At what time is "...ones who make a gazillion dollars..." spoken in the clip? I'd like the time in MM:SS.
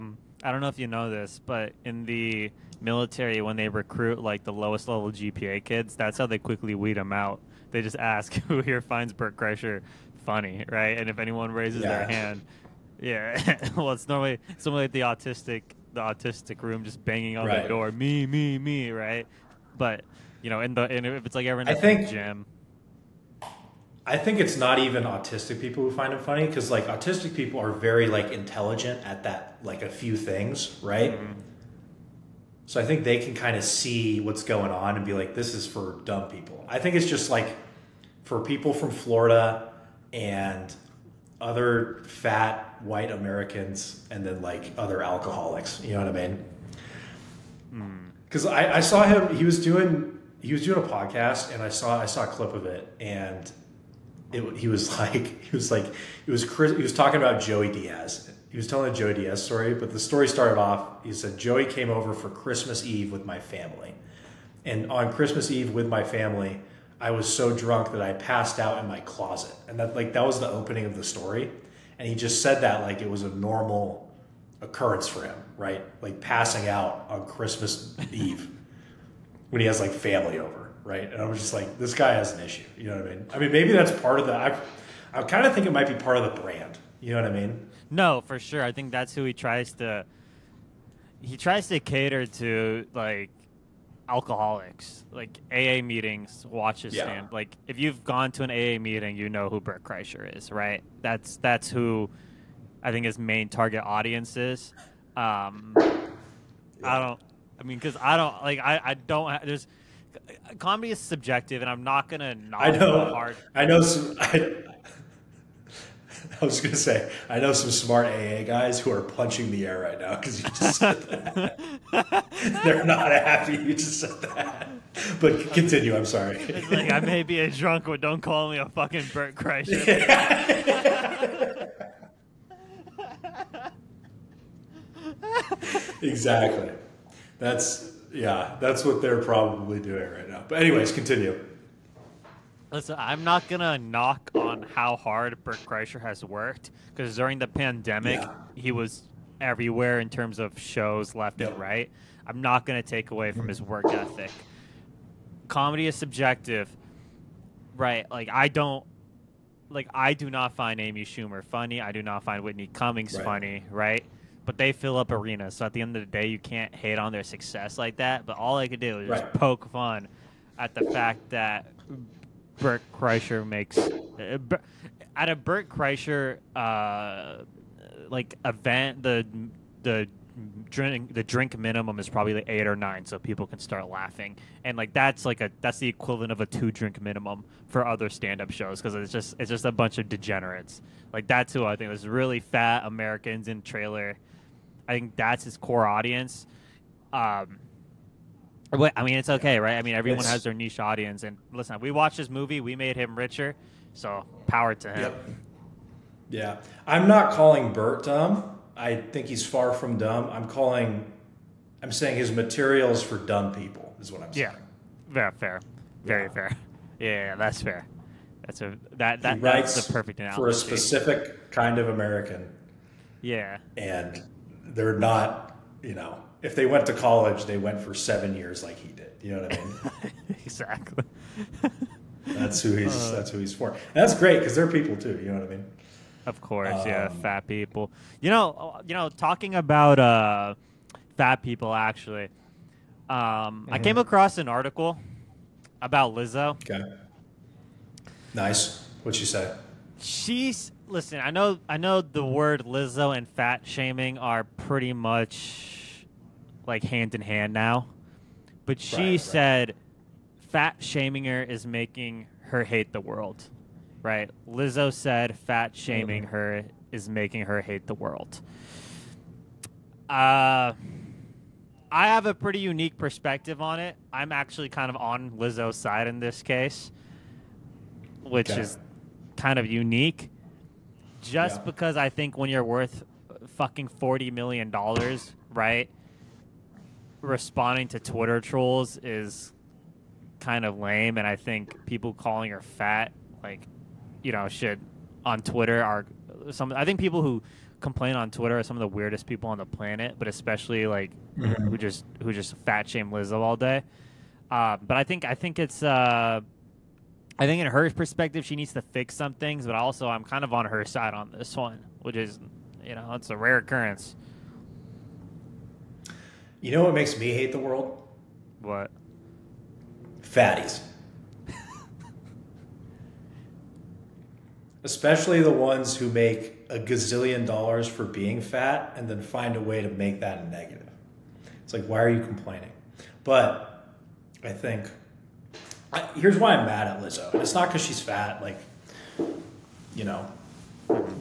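05:25.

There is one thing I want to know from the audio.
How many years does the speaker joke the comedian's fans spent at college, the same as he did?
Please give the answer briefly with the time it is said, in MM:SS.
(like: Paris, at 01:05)
7, at 03:47.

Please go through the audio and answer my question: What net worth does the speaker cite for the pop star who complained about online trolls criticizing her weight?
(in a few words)
$40 million.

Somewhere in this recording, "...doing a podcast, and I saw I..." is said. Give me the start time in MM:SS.
00:50.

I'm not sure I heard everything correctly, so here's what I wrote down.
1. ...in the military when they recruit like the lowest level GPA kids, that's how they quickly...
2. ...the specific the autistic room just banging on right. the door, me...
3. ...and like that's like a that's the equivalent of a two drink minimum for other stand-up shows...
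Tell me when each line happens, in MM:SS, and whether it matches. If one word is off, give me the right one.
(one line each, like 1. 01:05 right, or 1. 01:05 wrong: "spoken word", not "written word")
1. 00:01 right
2. 00:14 wrong: "autistic", not "specific"
3. 03:04 right.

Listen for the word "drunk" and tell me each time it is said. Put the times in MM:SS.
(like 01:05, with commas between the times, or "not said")
01:07, 02:07.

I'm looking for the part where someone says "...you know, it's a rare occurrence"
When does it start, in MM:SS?
05:12.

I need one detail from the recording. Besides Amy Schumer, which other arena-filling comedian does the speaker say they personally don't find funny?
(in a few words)
Whitney Cummings.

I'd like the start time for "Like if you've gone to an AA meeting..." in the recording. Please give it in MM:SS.
01:37.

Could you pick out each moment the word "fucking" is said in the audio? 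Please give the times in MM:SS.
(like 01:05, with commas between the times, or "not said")
02:08, 04:43.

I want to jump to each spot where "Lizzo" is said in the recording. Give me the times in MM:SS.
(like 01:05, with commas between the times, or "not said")
04:06, 04:12, 04:24, 04:35, 05:03, 05:37.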